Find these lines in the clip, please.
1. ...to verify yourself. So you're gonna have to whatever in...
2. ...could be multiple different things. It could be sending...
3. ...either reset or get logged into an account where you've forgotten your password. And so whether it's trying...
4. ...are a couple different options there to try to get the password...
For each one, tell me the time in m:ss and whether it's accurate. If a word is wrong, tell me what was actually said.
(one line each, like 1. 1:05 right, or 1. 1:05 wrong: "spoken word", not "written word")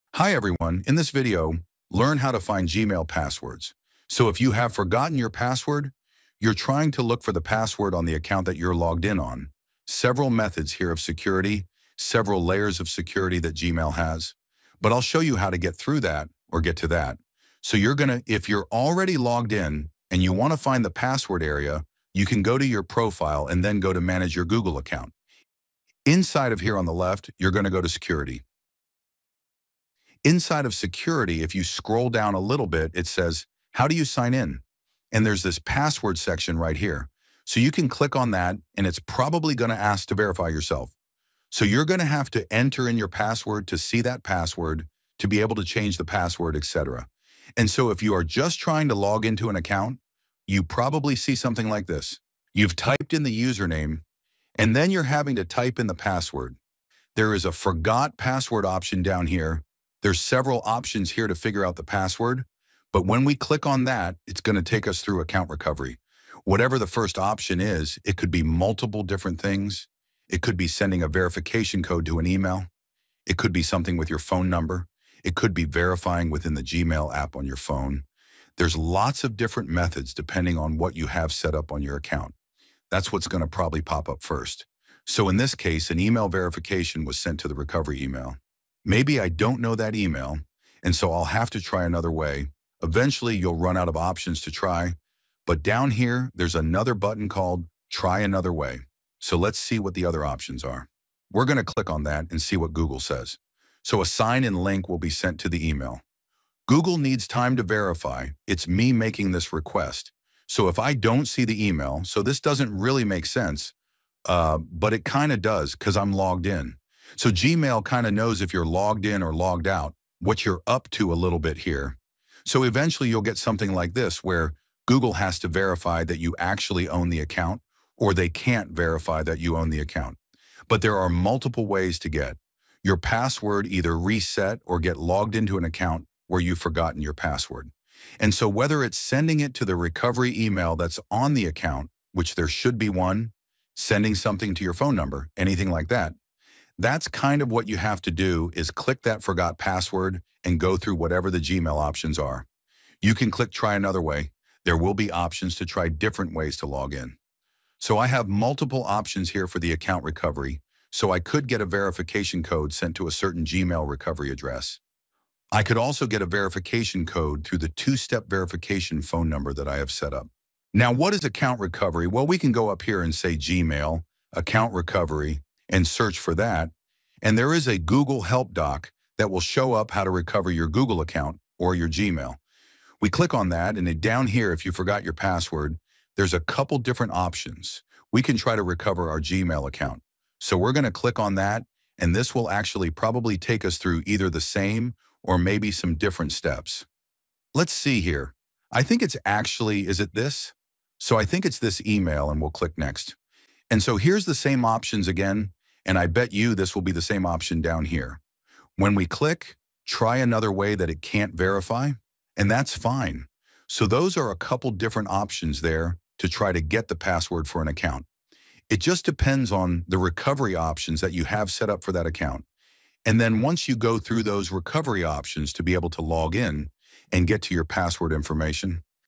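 1. 0:40 wrong: "enter", not "whatever"
2. 1:08 right
3. 2:13 wrong: "sending", not "trying"
4. 3:34 right.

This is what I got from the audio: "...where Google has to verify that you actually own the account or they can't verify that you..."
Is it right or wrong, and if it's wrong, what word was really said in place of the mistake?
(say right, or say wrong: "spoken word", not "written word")
right.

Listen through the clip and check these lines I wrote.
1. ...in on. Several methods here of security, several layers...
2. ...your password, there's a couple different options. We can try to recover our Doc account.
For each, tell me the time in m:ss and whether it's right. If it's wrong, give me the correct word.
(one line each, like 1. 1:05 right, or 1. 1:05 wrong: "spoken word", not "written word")
1. 0:09 right
2. 3:05 wrong: "Gmail", not "Doc".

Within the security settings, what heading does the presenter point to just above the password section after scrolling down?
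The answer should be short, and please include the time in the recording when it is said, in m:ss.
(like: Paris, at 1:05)
How do you sign in?, at 0:33.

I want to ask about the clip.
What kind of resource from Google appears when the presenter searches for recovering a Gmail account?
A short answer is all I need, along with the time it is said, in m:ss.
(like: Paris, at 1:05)
Google Help Doc, at 2:57.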